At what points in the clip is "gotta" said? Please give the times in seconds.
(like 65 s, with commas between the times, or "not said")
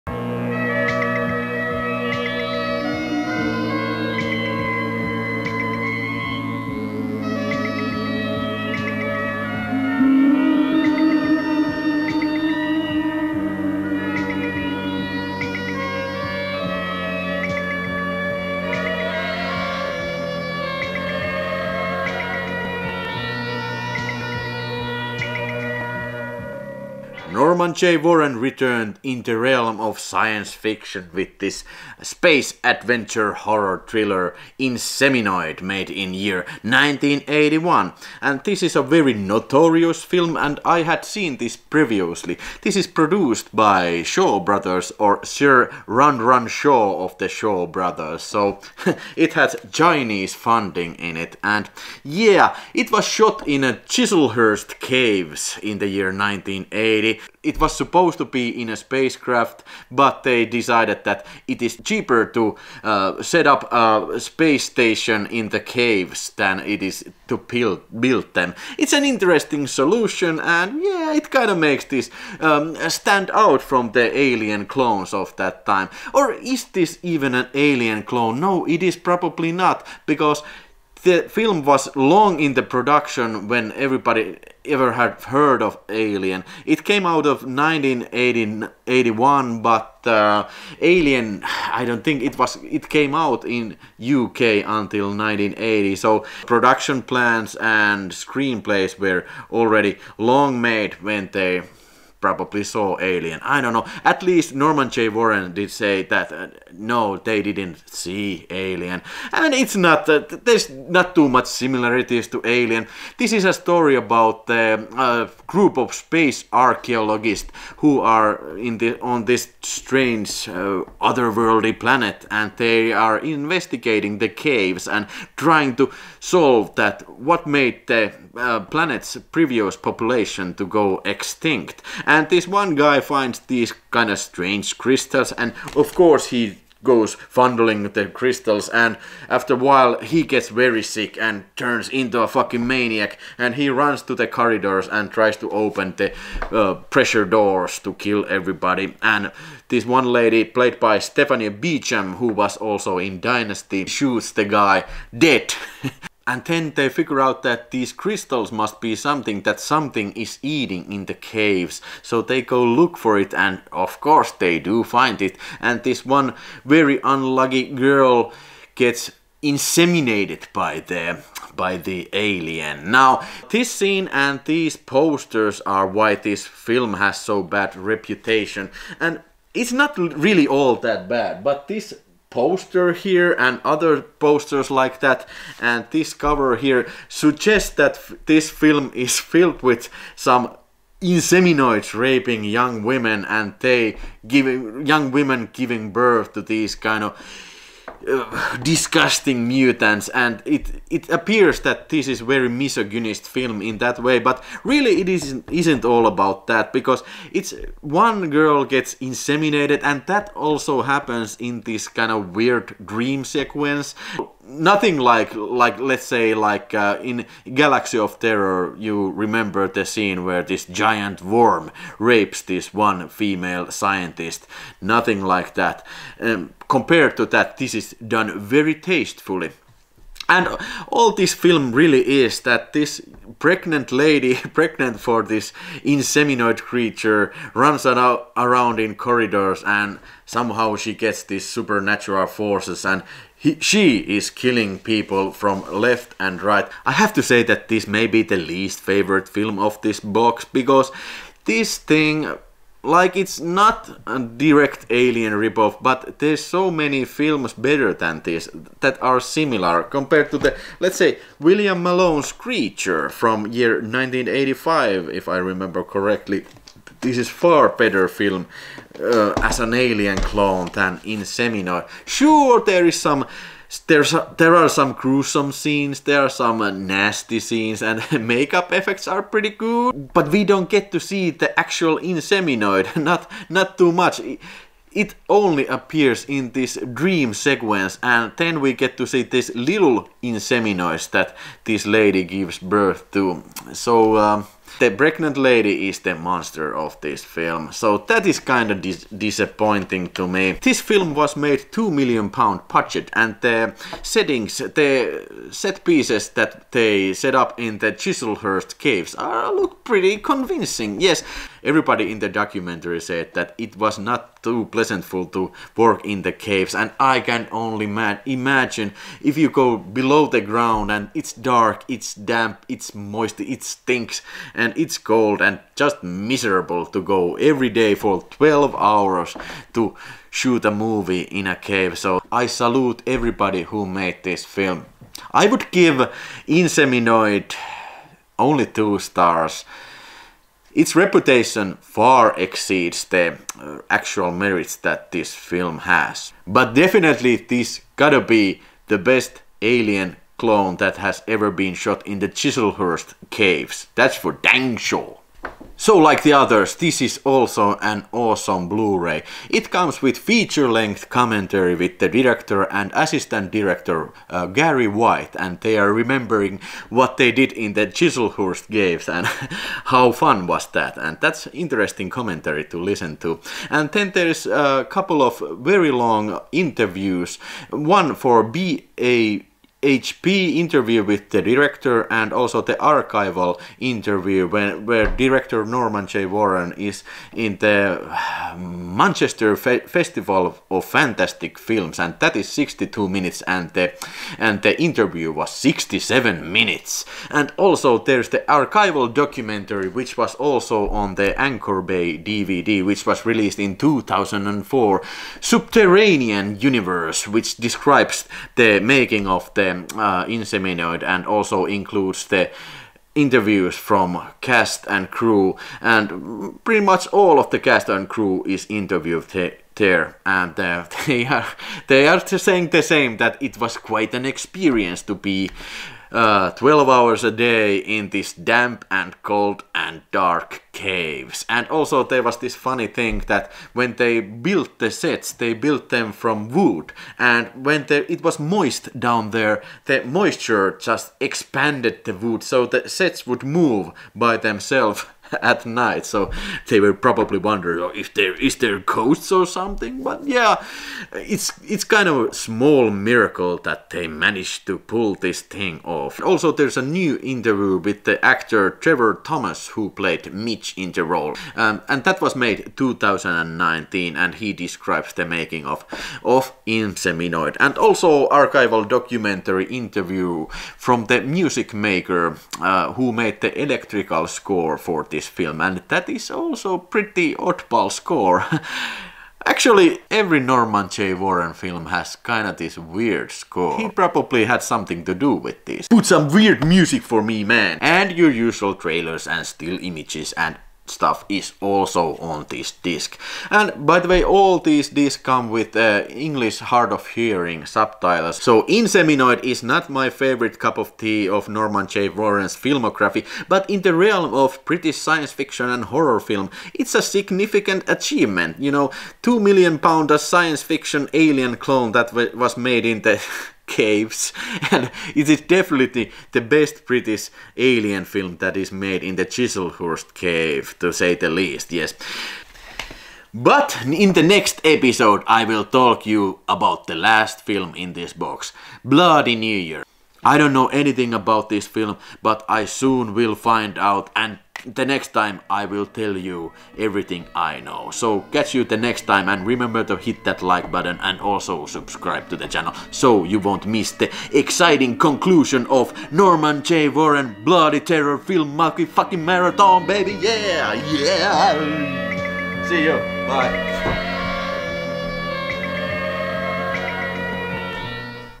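347 s.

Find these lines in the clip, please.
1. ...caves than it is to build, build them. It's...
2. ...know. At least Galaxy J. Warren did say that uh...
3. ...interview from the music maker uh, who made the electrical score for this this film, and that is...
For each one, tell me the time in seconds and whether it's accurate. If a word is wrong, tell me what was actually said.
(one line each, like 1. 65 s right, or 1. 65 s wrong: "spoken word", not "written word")
1. 65 s right
2. 103 s wrong: "Norman", not "Galaxy"
3. 469 s right.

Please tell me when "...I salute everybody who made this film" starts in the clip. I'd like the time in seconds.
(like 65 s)
332 s.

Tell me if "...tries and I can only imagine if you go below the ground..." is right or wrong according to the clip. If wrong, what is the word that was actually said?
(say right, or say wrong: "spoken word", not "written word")
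wrong: "caves", not "tries".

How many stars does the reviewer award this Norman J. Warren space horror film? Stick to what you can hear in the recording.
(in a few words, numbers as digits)
2.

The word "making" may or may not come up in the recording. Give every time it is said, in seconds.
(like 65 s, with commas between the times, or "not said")
408 s, 465 s.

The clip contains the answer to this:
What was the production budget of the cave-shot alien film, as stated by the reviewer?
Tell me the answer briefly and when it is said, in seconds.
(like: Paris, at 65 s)
2 million pounds, at 301 s.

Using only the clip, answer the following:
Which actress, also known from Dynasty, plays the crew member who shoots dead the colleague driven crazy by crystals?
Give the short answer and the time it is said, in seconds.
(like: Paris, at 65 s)
Stephanie Beecham, at 150 s.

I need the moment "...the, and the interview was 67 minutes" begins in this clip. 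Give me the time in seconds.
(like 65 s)
393 s.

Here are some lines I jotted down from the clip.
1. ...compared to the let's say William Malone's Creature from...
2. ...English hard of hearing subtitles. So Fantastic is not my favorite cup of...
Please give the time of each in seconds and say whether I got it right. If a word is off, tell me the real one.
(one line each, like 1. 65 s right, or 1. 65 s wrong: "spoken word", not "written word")
1. 259 s right
2. 496 s wrong: "Inseminoid", not "Fantastic".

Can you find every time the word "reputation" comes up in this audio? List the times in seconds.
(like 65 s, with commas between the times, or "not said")
177 s, 340 s.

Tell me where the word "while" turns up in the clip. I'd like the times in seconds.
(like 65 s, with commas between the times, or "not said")
139 s.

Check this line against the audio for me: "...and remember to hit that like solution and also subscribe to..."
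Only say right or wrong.
wrong.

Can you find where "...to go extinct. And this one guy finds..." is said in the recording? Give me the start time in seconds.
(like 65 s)
130 s.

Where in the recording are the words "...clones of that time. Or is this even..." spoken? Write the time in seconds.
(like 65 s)
74 s.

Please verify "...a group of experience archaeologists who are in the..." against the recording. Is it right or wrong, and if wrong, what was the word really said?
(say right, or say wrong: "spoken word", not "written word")
wrong: "space", not "experience".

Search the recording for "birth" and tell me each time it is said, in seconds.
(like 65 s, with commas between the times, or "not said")
195 s, 292 s.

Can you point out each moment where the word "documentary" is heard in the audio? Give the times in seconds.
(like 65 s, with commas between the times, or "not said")
312 s, 399 s, 468 s.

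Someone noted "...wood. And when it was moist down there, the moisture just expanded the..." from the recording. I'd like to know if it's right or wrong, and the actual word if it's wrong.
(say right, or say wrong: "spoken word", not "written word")
right.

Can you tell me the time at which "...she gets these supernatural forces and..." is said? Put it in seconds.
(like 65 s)
240 s.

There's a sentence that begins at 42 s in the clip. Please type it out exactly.
This is produced by Shaw Brothers or Sir Run Run Shaw of the Shaw Brothers.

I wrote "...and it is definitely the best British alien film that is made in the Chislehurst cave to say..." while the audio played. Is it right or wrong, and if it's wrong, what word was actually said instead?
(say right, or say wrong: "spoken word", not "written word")
right.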